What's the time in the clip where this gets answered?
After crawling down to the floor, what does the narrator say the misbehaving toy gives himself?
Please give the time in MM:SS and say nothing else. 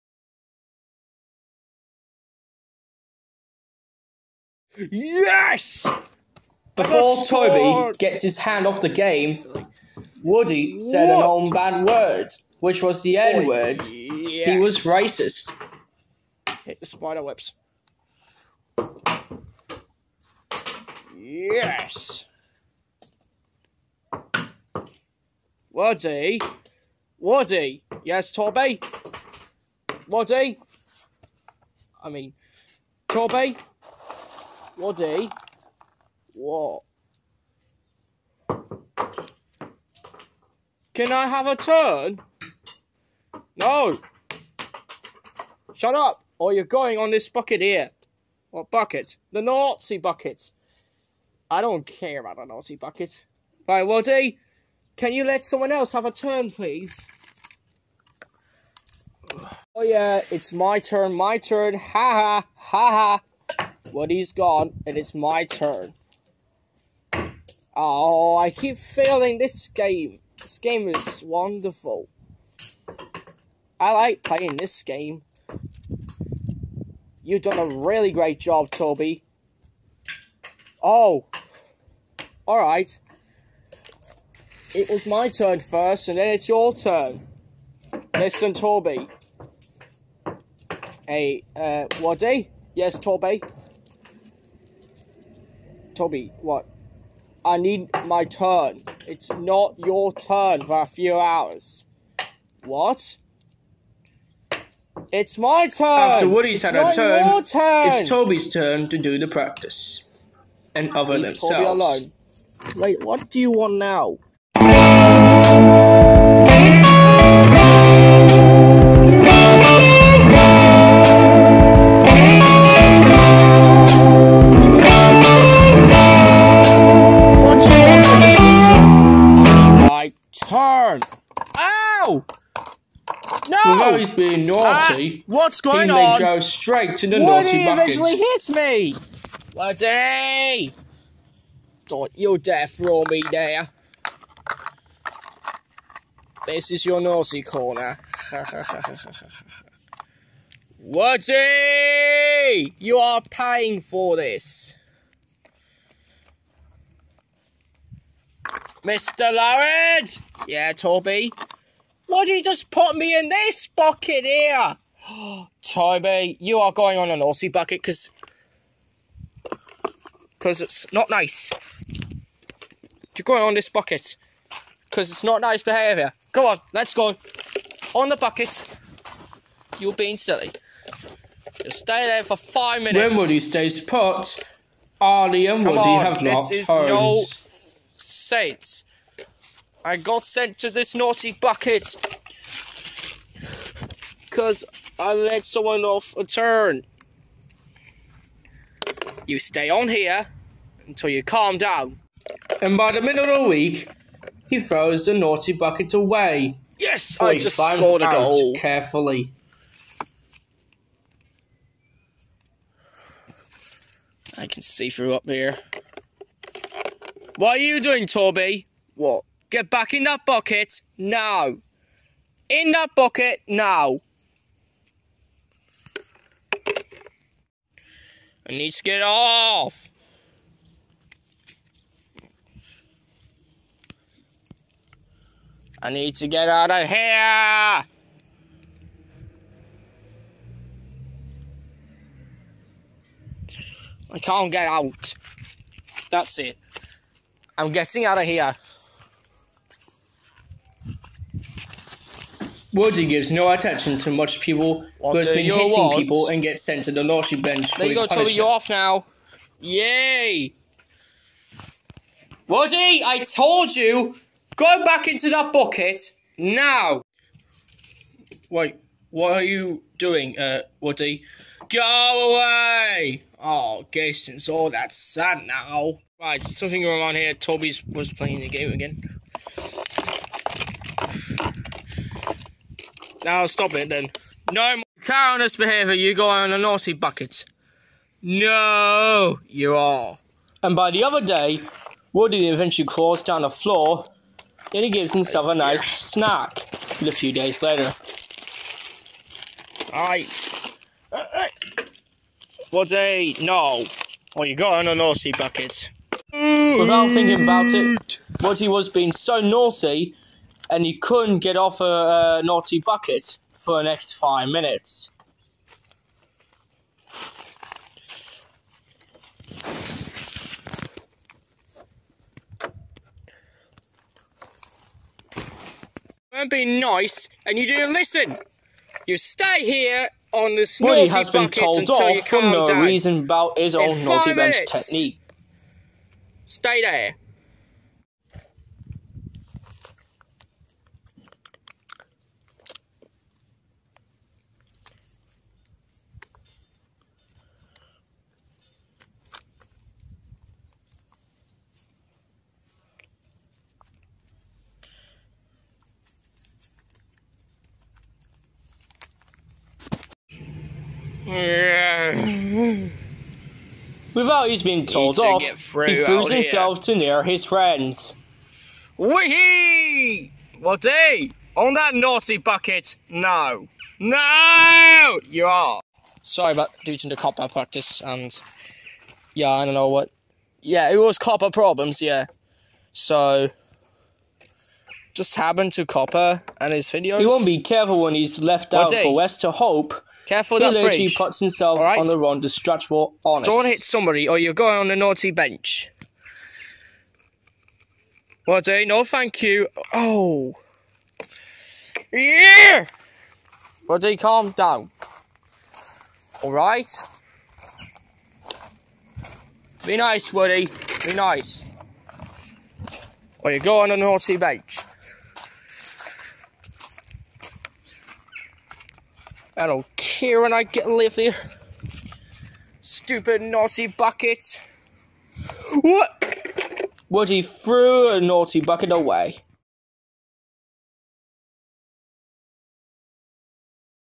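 04:55.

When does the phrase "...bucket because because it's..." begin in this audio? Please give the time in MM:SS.
02:47.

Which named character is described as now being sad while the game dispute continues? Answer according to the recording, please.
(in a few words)
Gaston.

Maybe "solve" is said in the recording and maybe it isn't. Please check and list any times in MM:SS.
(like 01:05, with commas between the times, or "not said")
not said.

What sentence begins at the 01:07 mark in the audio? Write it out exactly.
Oh, I keep failing this game.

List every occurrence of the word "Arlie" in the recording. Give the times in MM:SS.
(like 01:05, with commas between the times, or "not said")
03:04.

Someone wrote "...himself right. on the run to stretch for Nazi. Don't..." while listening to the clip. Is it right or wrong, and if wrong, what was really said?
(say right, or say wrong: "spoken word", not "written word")
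wrong: "Honest", not "Nazi".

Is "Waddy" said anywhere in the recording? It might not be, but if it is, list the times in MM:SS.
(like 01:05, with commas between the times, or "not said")
00:34, 00:53, 01:31.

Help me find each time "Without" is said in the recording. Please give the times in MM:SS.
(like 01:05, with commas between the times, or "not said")
05:06, 06:04.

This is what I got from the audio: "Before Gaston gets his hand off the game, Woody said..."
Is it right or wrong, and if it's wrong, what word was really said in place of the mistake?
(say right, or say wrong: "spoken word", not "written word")
wrong: "Toby", not "Gaston".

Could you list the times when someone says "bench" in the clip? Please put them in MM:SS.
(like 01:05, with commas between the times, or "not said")
04:17, 05:34, 06:35, 06:54.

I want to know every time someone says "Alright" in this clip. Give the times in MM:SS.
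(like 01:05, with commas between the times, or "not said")
01:22, 06:46.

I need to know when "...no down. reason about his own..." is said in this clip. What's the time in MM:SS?
05:32.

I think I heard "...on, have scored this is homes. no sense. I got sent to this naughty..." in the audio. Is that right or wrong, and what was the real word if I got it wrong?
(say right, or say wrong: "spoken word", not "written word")
wrong: "locked", not "scored".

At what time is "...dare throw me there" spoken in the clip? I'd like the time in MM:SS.
02:22.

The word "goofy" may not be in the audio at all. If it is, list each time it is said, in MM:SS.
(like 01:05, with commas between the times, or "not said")
not said.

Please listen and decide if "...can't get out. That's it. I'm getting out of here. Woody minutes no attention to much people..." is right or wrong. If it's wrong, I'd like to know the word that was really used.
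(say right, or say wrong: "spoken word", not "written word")
wrong: "gives", not "minutes".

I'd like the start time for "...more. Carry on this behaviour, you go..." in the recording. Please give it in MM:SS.
04:44.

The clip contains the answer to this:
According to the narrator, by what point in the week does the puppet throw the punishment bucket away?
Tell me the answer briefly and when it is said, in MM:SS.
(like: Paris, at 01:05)
the middle of the week, at 03:22.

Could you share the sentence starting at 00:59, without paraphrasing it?
Oh yeah, it's my turn, my turn.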